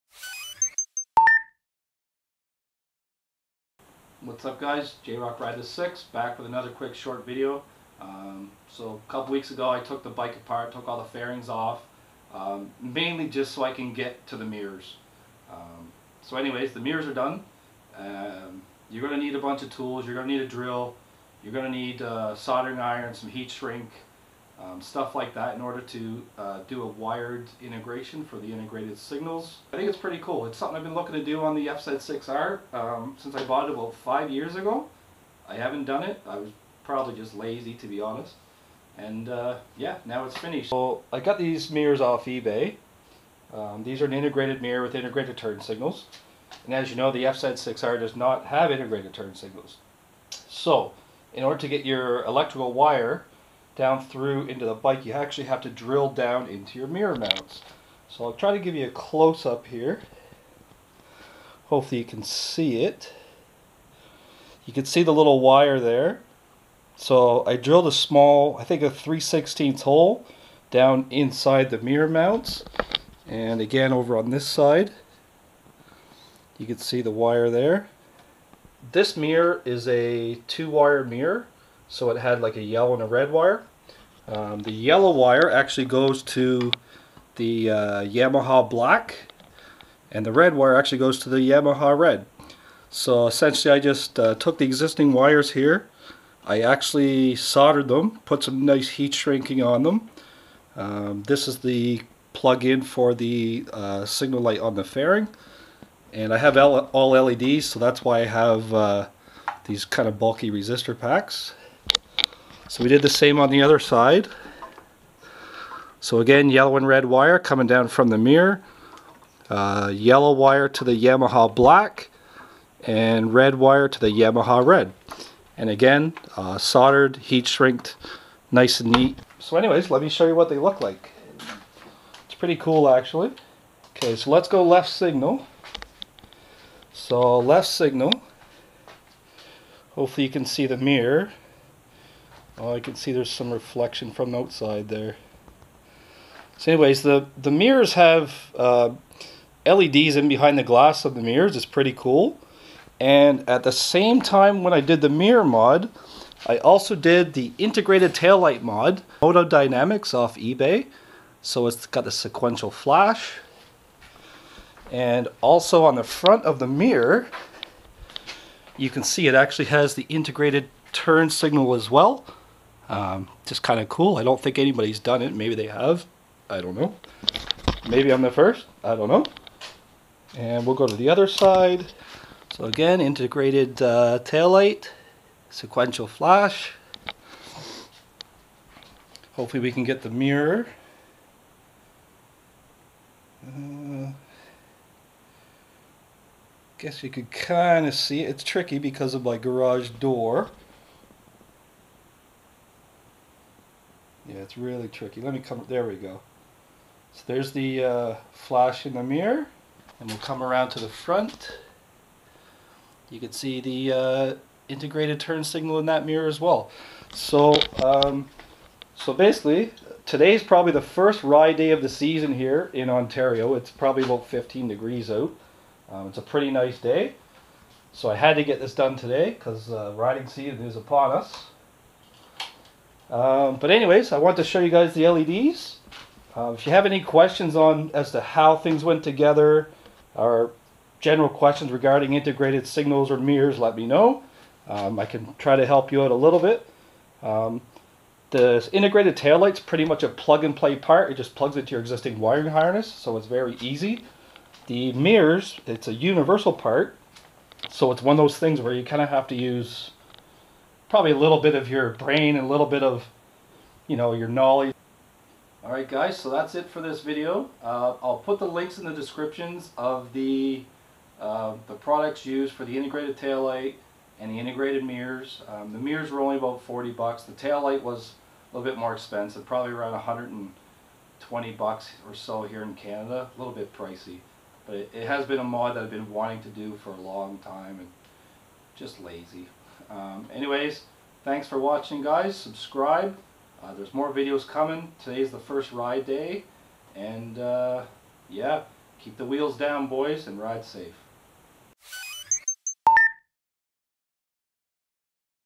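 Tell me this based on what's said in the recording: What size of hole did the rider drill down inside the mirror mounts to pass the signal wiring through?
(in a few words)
3/16.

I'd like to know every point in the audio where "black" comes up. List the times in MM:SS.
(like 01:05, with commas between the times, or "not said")
01:28, 02:01.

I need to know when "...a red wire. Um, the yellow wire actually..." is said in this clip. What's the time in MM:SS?
01:23.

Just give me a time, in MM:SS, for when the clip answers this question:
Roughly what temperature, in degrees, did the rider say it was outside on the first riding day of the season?
03:44.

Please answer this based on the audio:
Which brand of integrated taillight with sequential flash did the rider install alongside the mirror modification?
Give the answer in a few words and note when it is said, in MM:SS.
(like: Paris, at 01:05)
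Moto Dynamics, at 02:39.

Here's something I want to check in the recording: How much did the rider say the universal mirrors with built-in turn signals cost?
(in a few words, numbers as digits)
$40.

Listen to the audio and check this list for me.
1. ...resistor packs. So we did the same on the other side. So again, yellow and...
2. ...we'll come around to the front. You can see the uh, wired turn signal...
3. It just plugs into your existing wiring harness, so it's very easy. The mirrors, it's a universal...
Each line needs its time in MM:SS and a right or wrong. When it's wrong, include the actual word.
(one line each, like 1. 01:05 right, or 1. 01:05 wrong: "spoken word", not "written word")
1. 01:50 right
2. 03:30 wrong: "integrated", not "wired"
3. 04:11 right.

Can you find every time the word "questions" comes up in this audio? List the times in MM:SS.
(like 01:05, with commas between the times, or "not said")
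03:57, 04:01.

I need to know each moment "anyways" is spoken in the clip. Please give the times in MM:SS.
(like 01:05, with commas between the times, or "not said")
00:16, 02:09, 02:26, 03:53, 04:50.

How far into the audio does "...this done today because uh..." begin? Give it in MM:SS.
03:48.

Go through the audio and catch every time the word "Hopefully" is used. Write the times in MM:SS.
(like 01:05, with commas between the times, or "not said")
01:01, 02:19, 03:09.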